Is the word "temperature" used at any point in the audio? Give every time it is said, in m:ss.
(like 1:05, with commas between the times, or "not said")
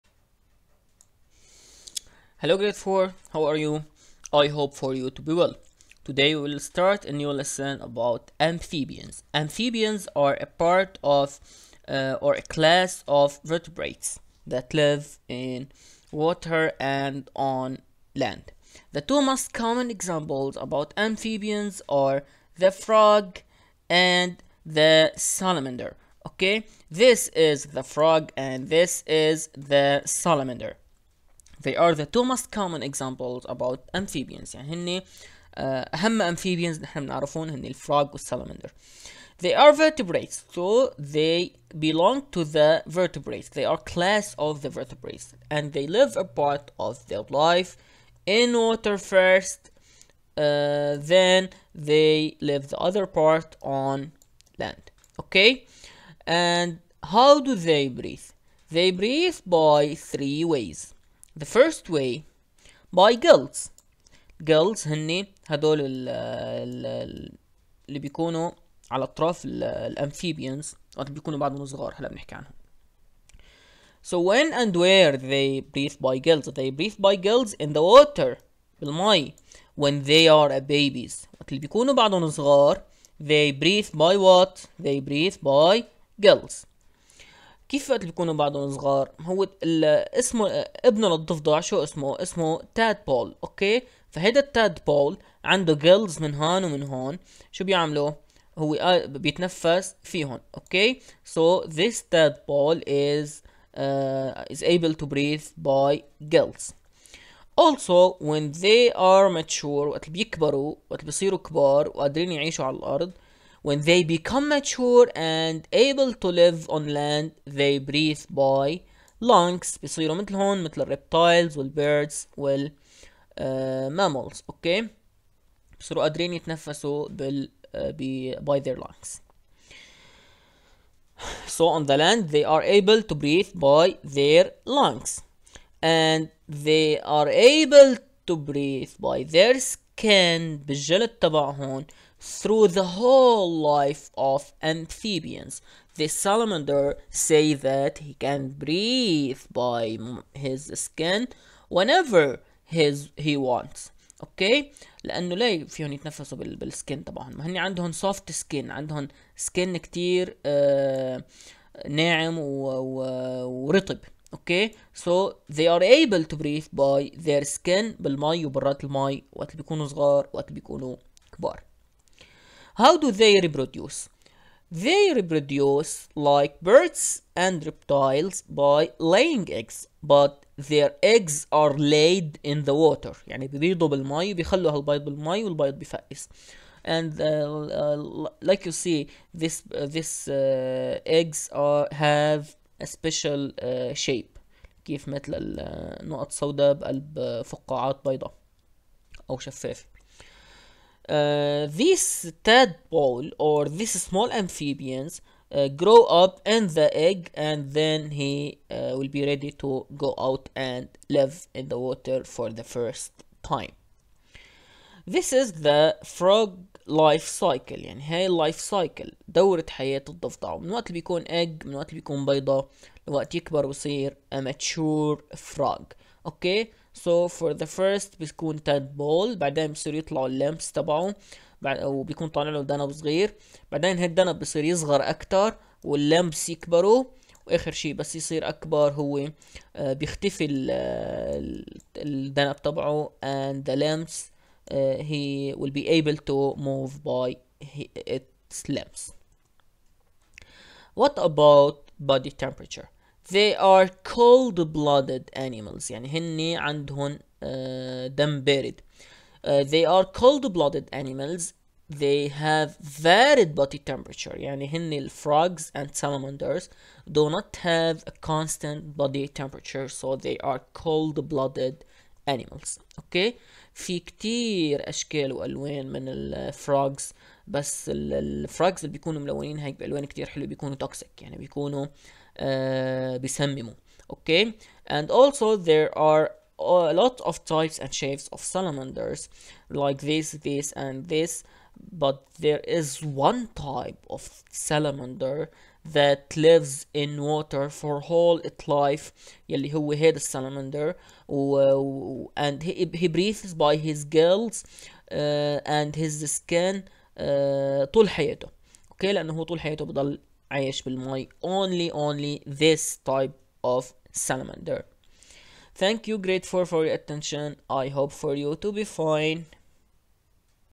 4:12, 4:23, 4:29.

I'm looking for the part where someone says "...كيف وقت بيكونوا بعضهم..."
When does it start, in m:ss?
1:27.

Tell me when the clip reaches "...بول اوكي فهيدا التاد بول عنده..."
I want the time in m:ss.
1:33.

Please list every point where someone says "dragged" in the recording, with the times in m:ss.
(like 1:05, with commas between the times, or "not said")
not said.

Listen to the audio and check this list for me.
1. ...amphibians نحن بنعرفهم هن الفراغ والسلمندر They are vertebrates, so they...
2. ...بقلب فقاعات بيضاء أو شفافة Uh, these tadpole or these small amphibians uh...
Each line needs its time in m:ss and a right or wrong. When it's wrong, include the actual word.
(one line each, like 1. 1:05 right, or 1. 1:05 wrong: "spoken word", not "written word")
1. 0:36 right
2. 3:16 right.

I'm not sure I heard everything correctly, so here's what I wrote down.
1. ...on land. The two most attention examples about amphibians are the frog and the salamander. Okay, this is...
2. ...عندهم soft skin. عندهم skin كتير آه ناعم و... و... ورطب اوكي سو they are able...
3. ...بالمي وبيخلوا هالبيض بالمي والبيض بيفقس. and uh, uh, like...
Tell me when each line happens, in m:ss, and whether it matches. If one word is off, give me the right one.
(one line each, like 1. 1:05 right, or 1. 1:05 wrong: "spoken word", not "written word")
1. 0:17 wrong: "common", not "attention"
2. 2:37 right
3. 3:03 right.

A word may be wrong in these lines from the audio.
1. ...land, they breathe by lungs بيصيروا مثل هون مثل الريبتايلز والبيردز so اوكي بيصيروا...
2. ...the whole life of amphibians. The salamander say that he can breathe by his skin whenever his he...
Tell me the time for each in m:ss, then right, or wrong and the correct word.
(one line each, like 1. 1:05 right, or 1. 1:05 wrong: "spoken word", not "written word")
1. 1:56 right
2. 2:22 right.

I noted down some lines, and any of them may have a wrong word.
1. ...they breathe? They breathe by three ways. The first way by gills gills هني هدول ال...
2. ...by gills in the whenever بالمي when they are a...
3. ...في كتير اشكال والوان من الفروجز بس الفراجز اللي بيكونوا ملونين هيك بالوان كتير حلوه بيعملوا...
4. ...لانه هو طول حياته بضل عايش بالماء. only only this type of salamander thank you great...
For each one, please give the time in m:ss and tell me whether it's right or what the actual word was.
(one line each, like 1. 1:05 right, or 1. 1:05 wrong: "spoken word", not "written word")
1. 0:57 right
2. 1:16 wrong: "water", not "whenever"
3. 4:33 wrong: "بيكونوا", not "بيعملوا"
4. 5:09 right.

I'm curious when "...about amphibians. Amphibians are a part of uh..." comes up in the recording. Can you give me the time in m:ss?
0:07.